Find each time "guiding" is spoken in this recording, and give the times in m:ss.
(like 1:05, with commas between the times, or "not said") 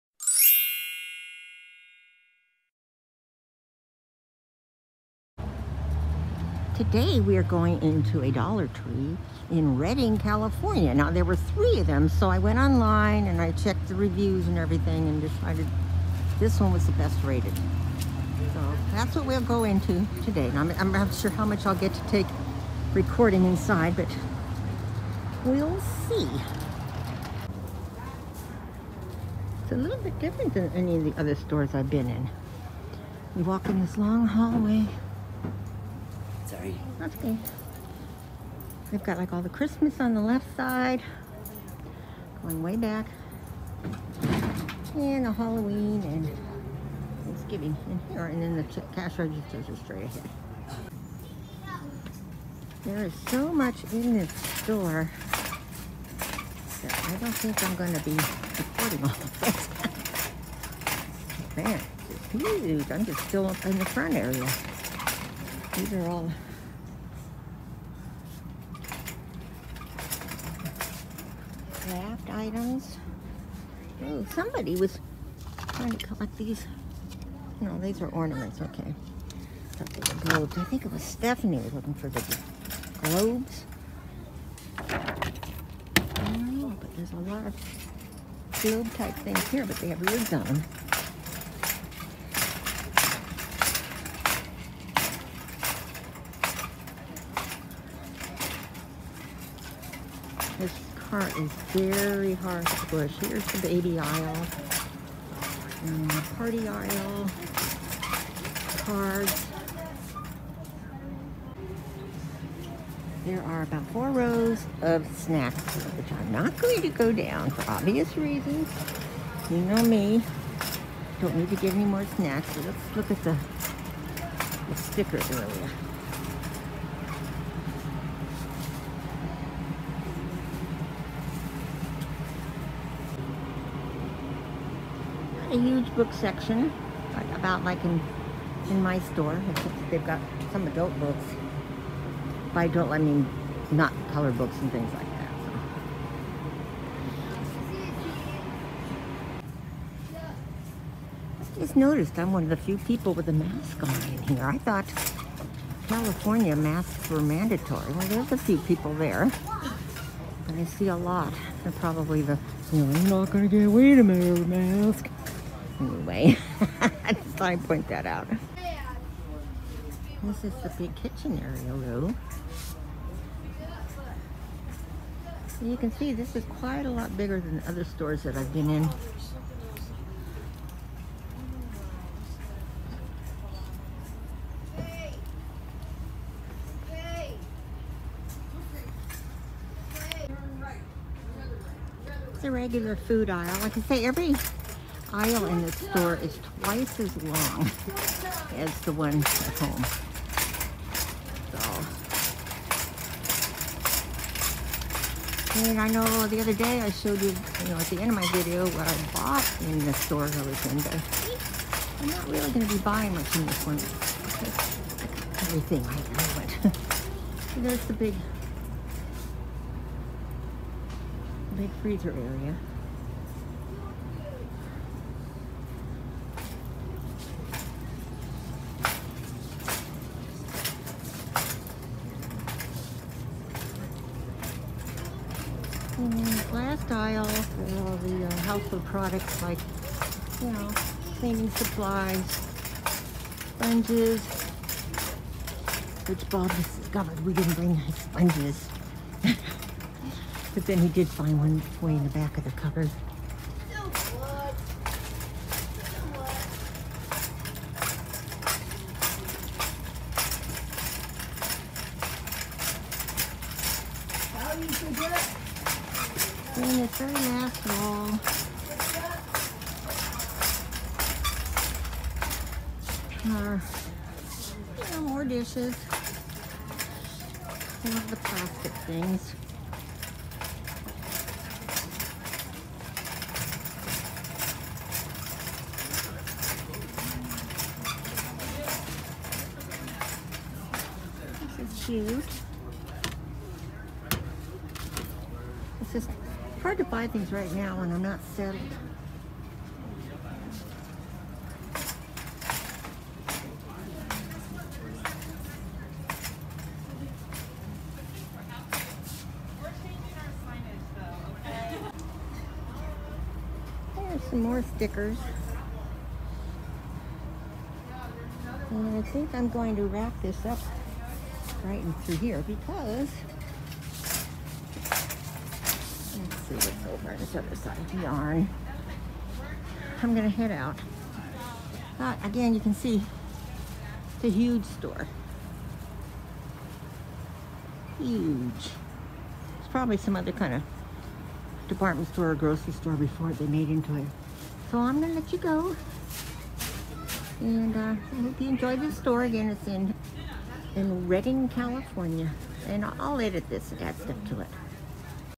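not said.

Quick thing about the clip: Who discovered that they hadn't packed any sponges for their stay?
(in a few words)
Bob.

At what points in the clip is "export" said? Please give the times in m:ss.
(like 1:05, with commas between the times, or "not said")
not said.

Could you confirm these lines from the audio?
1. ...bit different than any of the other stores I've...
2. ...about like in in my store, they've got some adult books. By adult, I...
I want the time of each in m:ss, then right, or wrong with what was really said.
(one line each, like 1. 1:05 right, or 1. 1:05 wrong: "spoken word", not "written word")
1. 0:29 right
2. 2:17 right.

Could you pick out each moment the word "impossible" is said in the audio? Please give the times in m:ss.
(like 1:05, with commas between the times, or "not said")
not said.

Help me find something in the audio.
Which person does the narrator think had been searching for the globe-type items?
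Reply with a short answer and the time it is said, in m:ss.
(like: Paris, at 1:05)
Stephanie, at 1:21.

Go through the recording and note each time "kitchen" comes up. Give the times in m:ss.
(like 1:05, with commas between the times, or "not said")
2:50.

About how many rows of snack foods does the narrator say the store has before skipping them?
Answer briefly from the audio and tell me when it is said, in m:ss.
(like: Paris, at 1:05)
4, at 1:53.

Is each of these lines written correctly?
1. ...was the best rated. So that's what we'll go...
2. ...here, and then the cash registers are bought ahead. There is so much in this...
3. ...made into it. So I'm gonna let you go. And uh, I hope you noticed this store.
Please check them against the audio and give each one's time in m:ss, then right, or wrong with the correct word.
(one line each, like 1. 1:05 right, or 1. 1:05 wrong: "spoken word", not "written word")
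1. 0:16 right
2. 0:48 wrong: "straight", not "bought"
3. 5:43 wrong: "enjoyed", not "noticed".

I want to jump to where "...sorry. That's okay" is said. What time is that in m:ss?
0:36.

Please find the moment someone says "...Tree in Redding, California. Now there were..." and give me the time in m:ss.
0:08.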